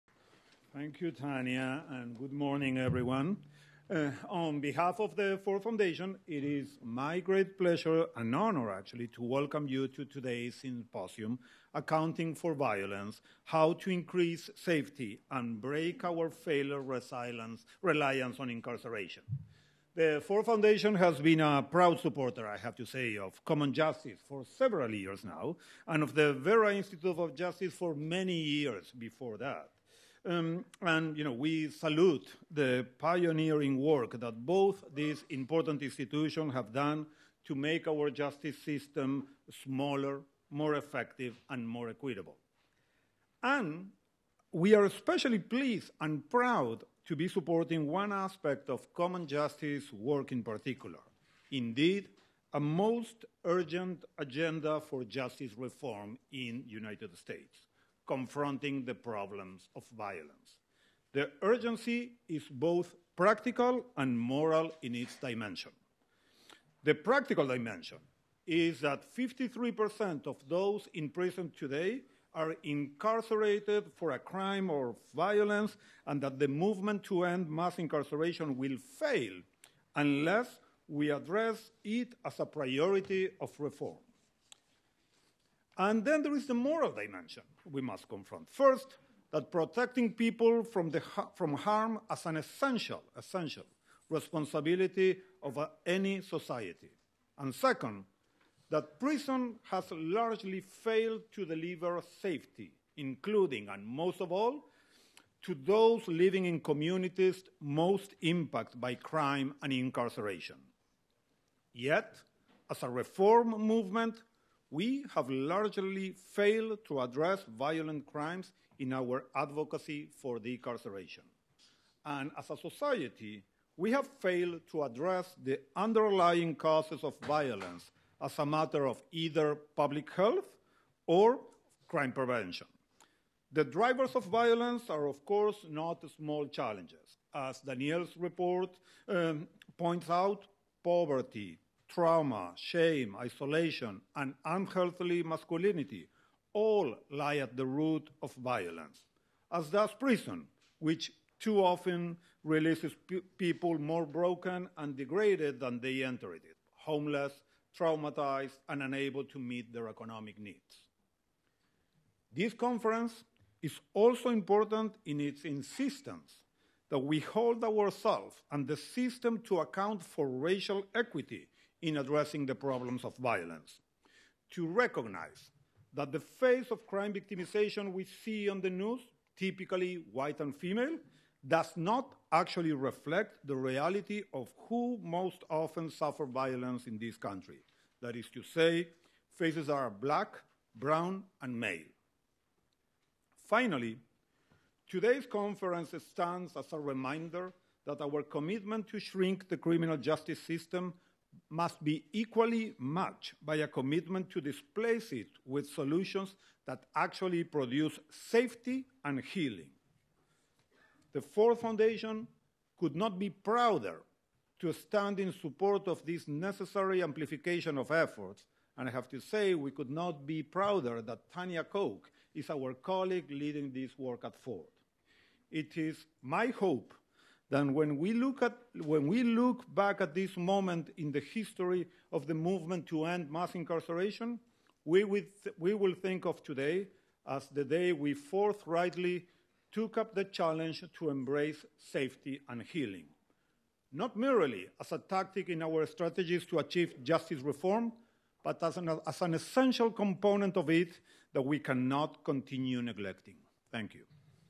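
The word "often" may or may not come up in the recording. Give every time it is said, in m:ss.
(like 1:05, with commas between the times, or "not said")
2:31, 3:05.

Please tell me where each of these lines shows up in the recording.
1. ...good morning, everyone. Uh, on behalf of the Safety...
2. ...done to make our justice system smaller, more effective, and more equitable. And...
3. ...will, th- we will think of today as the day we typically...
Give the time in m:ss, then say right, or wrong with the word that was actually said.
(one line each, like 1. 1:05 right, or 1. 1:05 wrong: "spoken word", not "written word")
1. 0:02 wrong: "Ford", not "Safety"
2. 0:36 right
3. 3:55 wrong: "forthrightly", not "typically".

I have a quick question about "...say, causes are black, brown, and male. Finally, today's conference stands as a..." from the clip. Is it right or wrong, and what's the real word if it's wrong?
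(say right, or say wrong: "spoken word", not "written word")
wrong: "faces", not "causes".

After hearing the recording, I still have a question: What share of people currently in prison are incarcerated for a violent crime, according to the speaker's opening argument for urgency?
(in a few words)
53%.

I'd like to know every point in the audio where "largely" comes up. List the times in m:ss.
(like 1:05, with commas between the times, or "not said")
1:39, 1:55.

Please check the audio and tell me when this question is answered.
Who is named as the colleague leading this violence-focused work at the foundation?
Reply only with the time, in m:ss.
3:41.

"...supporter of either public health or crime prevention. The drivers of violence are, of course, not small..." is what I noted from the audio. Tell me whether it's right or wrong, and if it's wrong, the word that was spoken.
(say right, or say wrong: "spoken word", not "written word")
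wrong: "matter", not "supporter".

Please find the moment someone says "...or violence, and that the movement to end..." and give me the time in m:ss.
1:14.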